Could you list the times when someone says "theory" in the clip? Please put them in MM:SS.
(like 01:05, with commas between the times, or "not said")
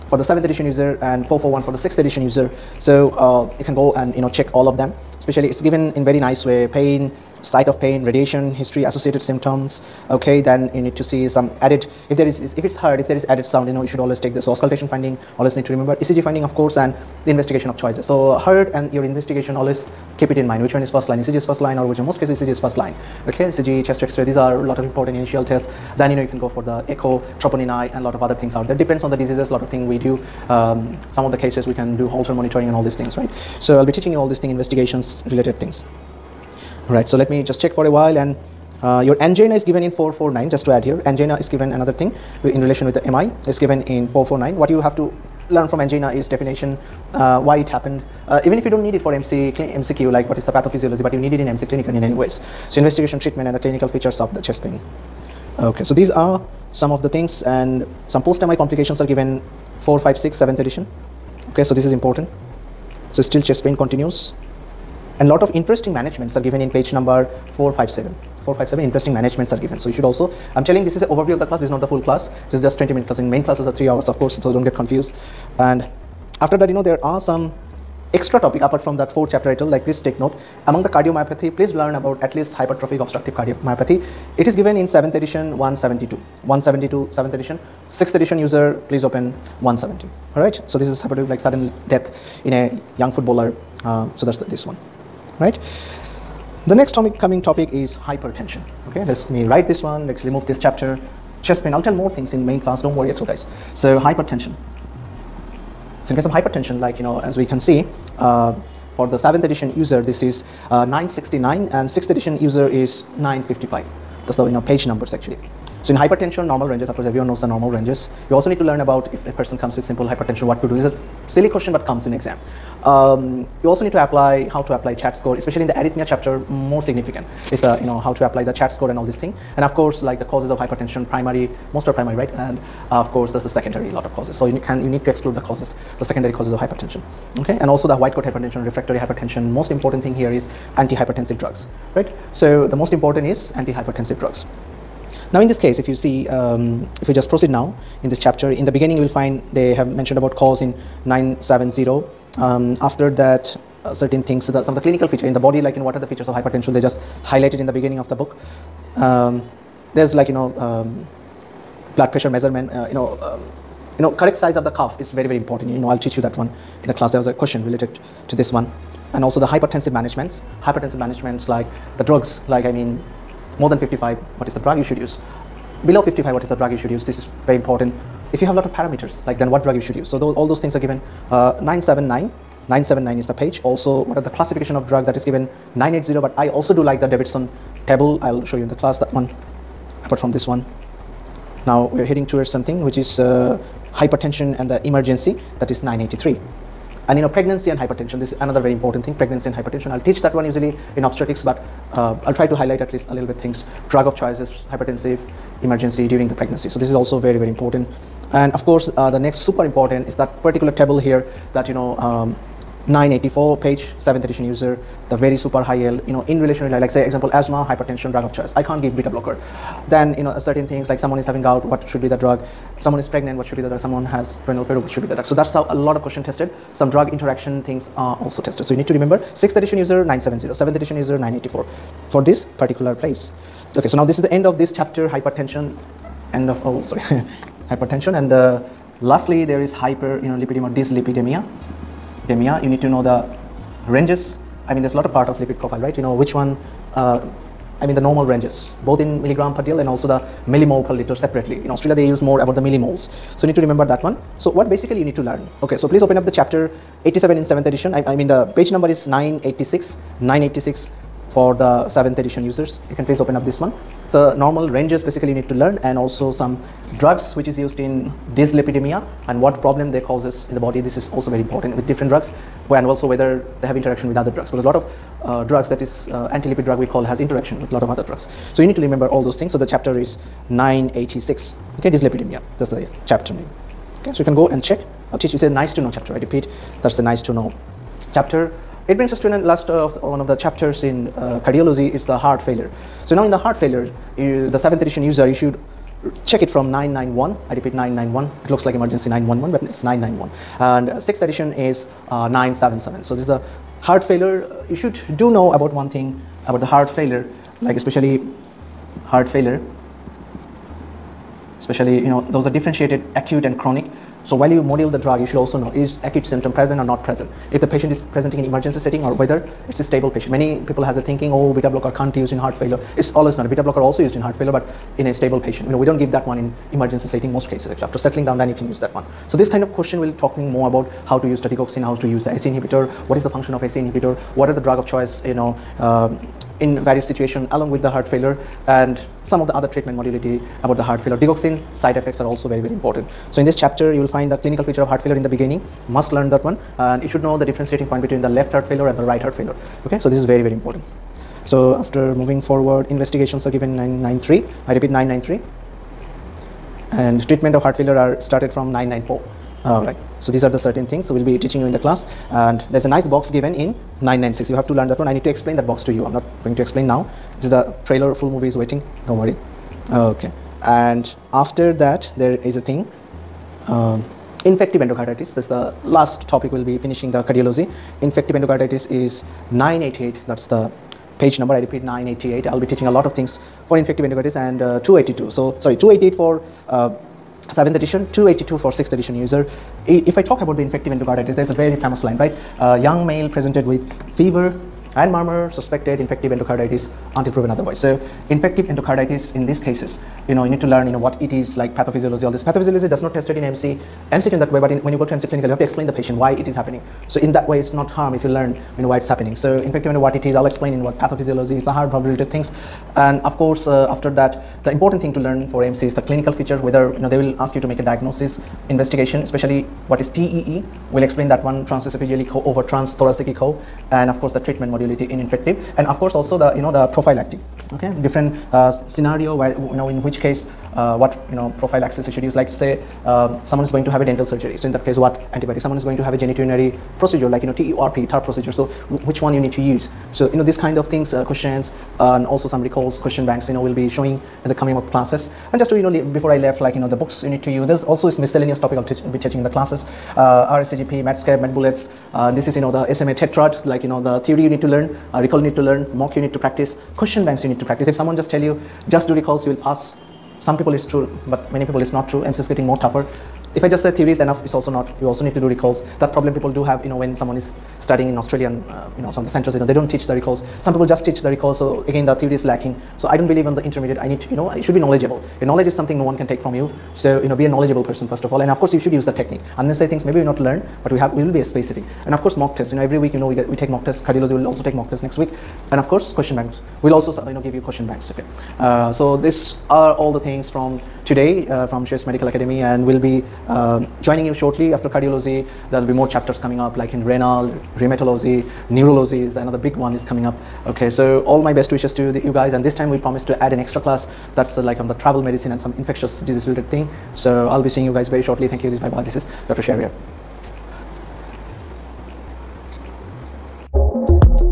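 07:34, 07:43, 07:52.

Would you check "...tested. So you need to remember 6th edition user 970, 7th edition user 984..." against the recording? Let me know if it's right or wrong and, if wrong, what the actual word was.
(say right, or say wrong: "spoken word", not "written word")
right.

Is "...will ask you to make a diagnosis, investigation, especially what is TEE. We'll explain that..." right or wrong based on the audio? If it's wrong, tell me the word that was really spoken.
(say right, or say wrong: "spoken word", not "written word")
right.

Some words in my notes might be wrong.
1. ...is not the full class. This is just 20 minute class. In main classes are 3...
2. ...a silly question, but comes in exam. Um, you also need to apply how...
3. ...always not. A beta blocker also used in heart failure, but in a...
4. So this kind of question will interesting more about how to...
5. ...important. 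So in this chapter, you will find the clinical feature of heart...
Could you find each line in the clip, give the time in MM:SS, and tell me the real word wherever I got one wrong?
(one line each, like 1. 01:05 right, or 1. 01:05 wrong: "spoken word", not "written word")
1. 01:11 right
2. 02:00 right
3. 05:23 right
4. 05:29 wrong: "talking", not "interesting"
5. 05:42 right.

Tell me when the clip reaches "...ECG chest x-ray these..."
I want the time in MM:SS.
00:23.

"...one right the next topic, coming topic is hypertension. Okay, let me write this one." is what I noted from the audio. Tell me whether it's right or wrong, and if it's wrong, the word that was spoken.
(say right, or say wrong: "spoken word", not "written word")
right.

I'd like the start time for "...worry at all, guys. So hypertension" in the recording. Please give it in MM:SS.
01:42.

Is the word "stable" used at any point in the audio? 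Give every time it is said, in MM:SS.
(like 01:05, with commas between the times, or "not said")
05:19, 05:25.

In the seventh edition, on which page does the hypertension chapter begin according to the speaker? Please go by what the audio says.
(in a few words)
969.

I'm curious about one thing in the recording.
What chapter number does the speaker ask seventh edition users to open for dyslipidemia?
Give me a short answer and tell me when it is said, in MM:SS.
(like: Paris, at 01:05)
87, at 04:17.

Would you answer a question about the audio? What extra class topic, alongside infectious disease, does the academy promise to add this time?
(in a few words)
Travel medicine.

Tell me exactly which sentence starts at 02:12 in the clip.
And uh, of course, there's the secondary lot of causes.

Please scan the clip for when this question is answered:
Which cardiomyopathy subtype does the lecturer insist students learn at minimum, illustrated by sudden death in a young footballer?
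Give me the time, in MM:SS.
01:22.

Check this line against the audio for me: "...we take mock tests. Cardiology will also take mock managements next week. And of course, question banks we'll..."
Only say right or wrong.
wrong.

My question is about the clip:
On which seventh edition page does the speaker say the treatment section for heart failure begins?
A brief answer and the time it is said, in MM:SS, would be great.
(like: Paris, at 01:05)
994, at 05:58.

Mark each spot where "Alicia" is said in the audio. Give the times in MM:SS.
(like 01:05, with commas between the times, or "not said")
not said.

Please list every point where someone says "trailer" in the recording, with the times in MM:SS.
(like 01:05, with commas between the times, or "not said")
06:07.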